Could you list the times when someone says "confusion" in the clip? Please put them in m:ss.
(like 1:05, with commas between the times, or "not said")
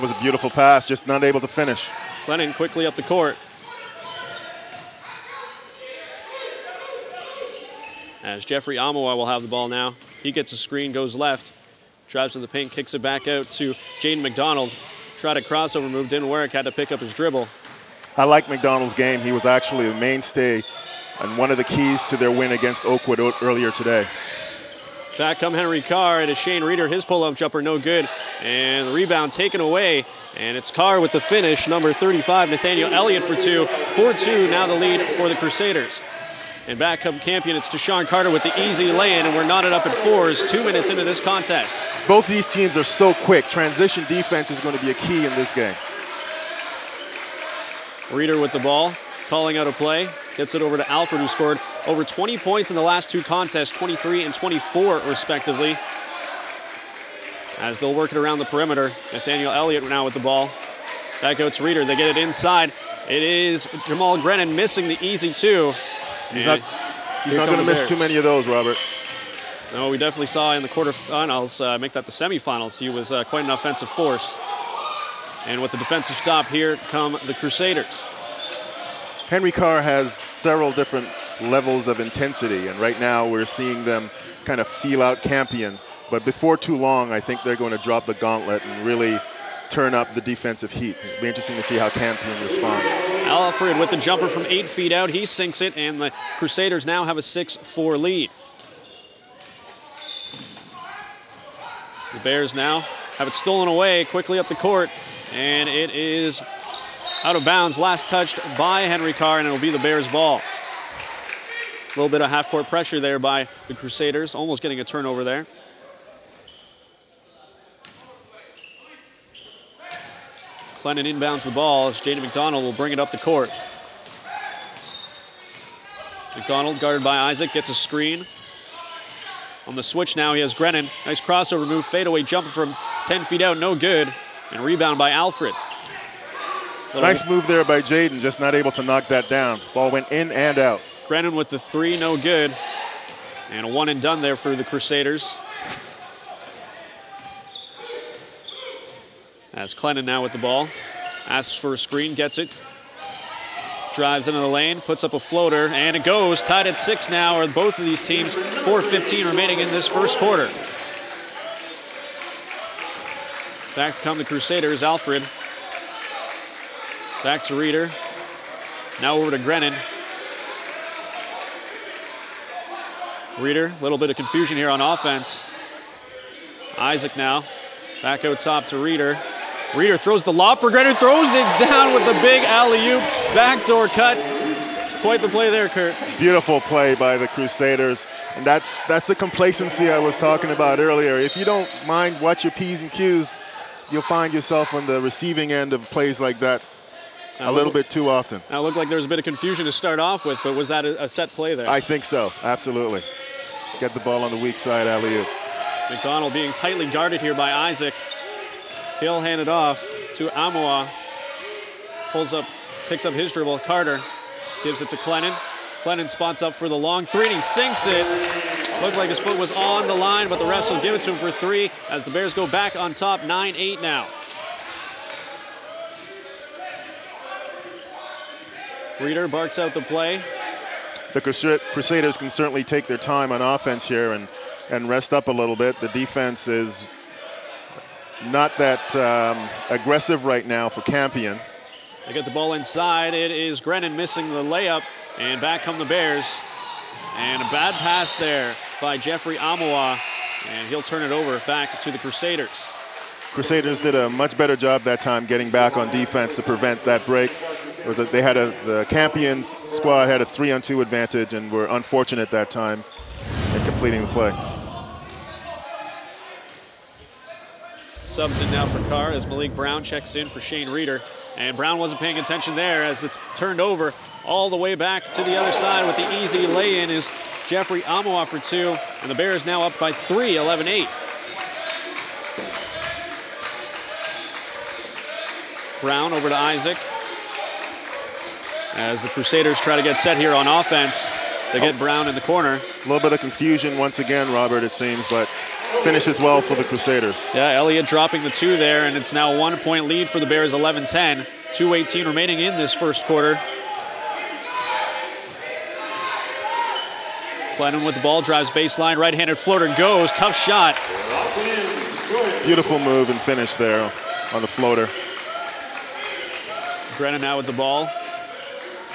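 2:54, 3:19, 4:53.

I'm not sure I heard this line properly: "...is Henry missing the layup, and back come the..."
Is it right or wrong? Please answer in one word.
wrong.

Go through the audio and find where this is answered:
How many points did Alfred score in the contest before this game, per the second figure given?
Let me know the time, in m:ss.
0:54.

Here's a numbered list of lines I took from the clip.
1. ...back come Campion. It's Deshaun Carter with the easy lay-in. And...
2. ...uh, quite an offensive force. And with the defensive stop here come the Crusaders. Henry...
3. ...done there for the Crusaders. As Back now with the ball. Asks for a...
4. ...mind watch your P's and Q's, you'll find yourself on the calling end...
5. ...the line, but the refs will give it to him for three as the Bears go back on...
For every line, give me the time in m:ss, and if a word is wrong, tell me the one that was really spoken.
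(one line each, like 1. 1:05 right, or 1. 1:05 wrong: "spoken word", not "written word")
1. 0:36 right
2. 1:13 right
3. 2:24 wrong: "Clennon", not "Back"
4. 3:11 wrong: "receiving", not "calling"
5. 3:39 right.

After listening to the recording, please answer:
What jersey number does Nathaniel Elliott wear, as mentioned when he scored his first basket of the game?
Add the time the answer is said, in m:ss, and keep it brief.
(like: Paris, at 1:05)
35, at 0:31.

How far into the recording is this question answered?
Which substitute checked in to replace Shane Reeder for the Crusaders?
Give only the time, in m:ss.
4:29.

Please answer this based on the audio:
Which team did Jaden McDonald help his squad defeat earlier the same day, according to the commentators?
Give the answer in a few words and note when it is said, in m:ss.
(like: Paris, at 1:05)
Oakwood, at 0:22.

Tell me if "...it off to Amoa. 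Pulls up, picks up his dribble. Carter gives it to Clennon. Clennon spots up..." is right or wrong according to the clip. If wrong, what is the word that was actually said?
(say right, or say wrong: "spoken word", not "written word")
right.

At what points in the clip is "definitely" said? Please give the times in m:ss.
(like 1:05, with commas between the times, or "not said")
1:09.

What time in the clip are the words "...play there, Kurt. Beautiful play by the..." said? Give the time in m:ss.
3:05.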